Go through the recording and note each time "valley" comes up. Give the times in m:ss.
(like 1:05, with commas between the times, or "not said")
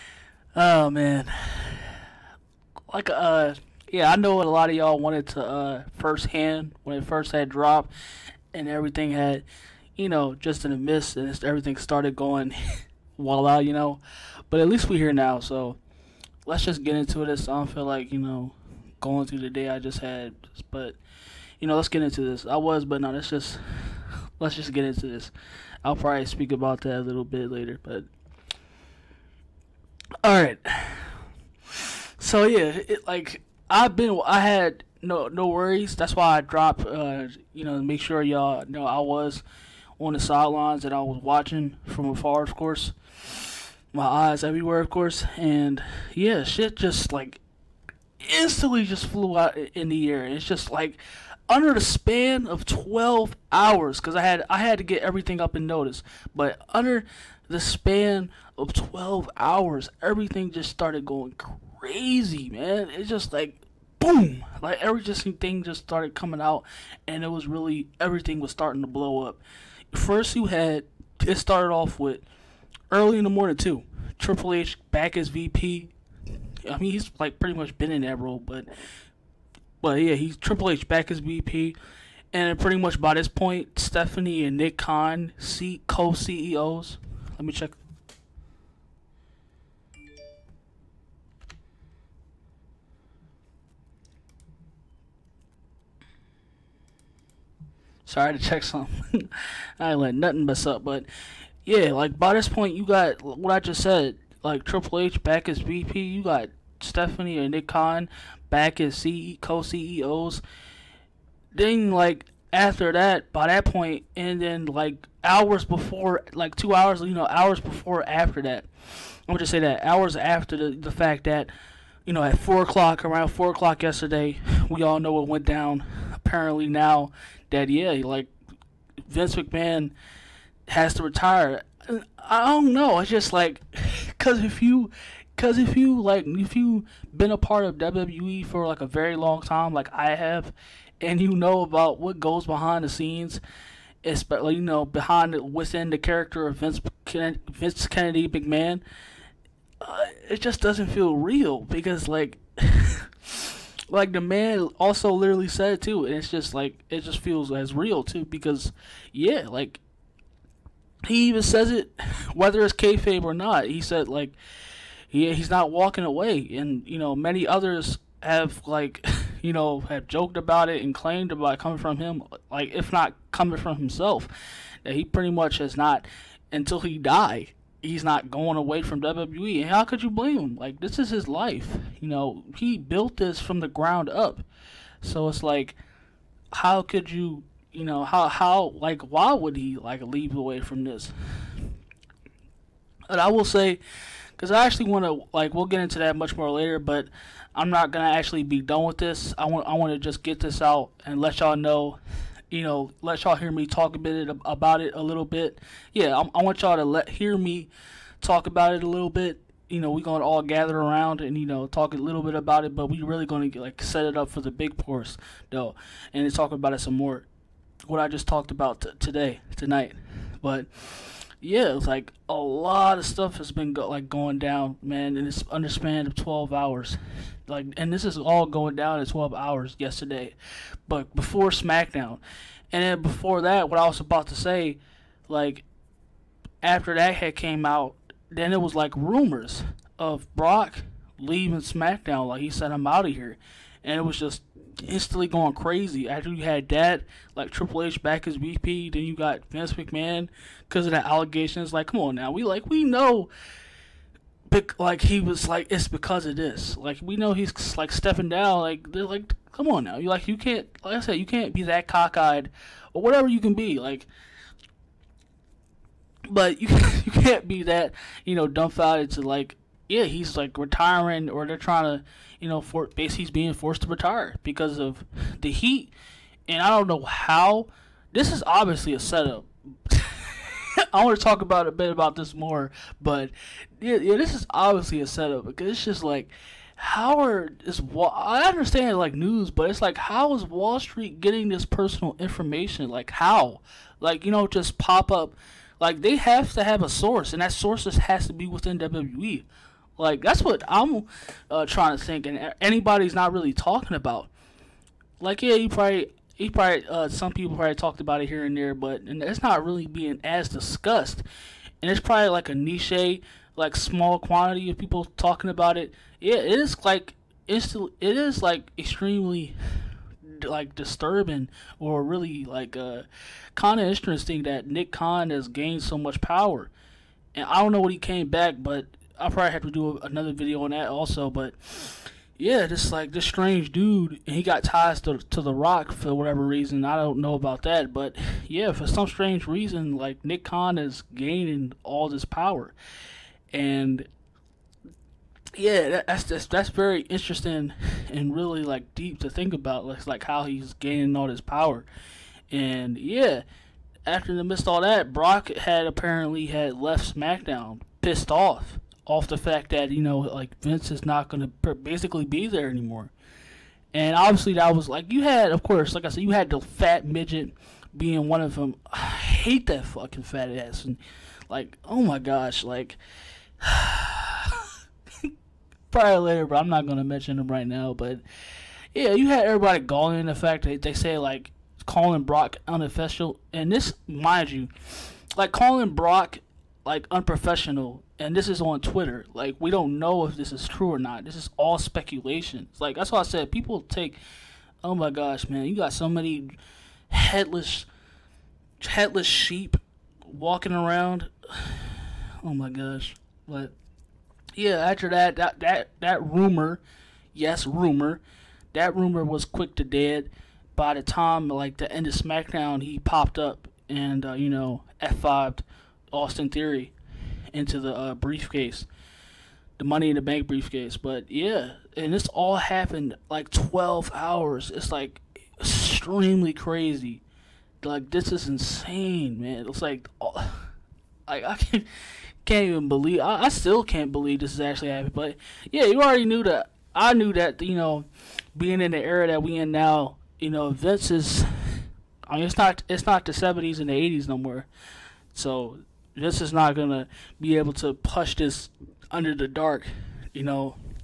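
not said.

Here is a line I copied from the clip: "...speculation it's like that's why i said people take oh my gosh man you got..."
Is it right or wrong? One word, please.
right.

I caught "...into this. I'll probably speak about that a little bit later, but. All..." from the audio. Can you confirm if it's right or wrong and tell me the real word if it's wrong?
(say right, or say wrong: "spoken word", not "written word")
right.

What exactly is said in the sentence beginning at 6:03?
And obviously that was like you had, of course, like I said, you had the fat midget being one of them.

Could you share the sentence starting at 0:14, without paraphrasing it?
But at least we're here now, so let's just get into this.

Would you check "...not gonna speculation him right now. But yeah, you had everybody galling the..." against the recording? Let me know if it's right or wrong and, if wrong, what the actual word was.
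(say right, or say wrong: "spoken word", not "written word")
wrong: "mention", not "speculation".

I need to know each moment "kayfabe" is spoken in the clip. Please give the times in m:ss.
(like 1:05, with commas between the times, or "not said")
2:42.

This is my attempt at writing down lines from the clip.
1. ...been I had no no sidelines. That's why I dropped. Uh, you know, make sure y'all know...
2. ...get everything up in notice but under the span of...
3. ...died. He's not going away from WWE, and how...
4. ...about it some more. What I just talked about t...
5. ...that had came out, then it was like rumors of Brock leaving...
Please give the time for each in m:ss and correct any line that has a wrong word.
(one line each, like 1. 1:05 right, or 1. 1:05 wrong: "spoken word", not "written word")
1. 0:33 wrong: "worries", not "sidelines"
2. 0:54 right
3. 2:56 right
4. 3:36 right
5. 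3:56 right.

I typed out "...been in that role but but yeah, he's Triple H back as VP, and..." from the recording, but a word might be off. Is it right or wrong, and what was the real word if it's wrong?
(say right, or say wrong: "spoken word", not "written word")
right.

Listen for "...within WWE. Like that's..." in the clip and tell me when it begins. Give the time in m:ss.
4:58.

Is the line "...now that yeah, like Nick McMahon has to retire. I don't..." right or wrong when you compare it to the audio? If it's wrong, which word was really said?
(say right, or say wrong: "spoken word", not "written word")
wrong: "Vince", not "Nick".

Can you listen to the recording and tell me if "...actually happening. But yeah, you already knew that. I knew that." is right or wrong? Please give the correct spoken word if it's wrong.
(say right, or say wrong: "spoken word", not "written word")
right.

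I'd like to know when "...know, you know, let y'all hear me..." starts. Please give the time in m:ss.
3:21.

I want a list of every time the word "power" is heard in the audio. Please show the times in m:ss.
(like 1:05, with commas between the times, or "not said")
5:26, 5:42, 5:51.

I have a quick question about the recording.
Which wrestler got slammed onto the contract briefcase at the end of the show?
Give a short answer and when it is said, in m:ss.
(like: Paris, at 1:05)
Austin Theory, at 6:56.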